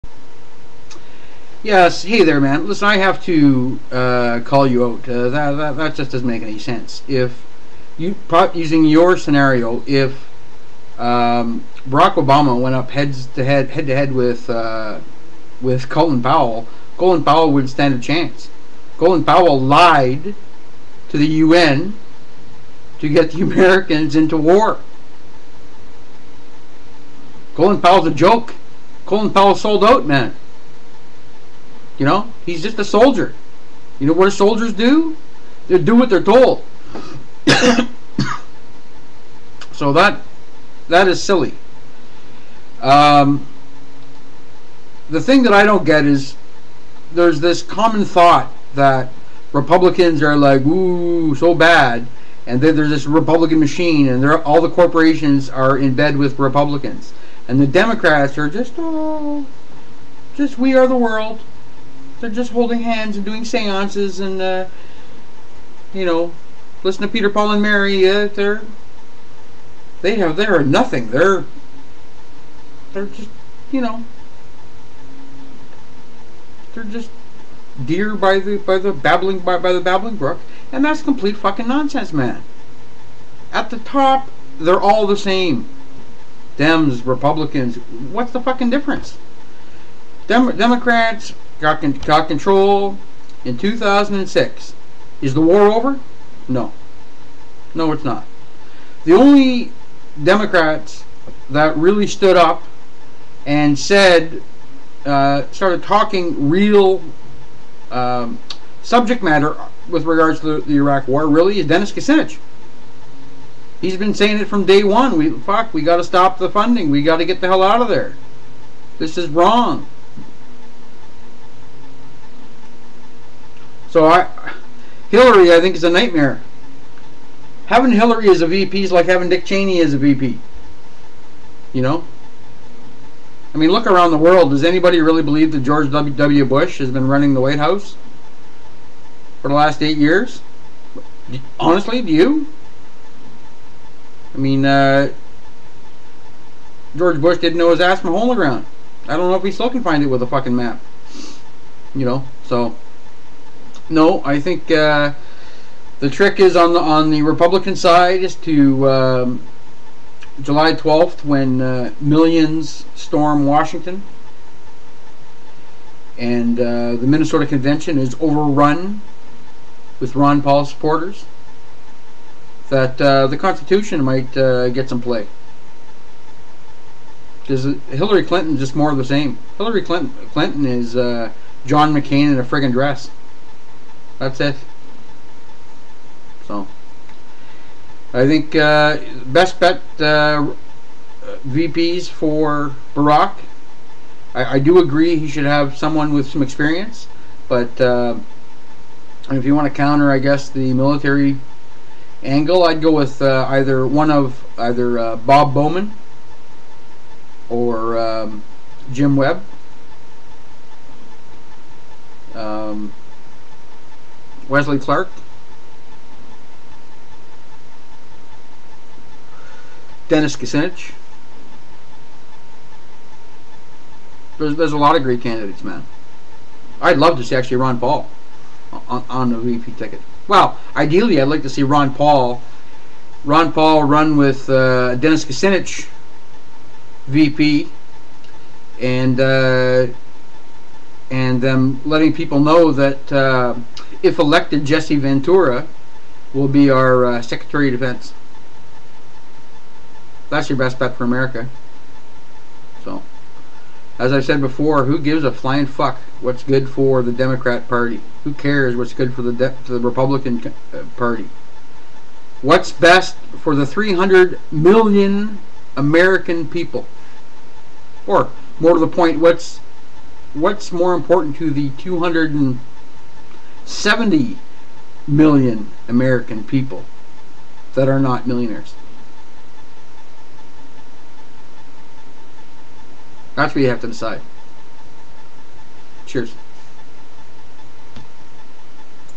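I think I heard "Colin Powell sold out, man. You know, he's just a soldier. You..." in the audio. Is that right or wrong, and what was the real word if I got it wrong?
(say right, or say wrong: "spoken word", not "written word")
right.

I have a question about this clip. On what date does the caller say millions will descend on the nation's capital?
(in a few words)
July 12th.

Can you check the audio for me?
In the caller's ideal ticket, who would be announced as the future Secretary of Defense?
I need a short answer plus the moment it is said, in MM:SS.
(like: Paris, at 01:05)
Jesse Ventura, at 04:04.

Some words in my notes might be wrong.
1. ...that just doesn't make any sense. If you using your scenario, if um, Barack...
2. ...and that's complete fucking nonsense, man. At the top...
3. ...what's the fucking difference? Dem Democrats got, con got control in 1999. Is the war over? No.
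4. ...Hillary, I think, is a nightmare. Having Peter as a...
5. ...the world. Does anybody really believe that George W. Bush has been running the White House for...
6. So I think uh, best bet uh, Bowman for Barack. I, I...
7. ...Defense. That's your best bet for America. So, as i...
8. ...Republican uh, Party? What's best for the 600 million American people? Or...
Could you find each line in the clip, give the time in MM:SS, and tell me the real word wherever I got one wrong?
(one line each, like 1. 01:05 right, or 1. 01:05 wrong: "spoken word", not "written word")
1. 00:05 right
2. 01:20 right
3. 01:28 wrong: "2006", not "1999"
4. 02:05 wrong: "Hillary", not "Peter"
5. 02:14 right
6. 03:06 wrong: "VPs", not "Bowman"
7. 04:07 right
8. 04:19 wrong: "300", not "600".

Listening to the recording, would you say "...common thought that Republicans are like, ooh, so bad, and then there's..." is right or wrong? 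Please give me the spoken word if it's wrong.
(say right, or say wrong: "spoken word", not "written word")
right.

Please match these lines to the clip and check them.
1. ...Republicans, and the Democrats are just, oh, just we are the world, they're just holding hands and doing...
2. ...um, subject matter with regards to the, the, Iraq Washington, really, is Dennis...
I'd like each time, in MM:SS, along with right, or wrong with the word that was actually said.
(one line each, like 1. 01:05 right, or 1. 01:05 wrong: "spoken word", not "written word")
1. 00:56 right
2. 01:47 wrong: "War", not "Washington".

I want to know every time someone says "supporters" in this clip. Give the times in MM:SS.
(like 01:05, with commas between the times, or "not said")
02:50.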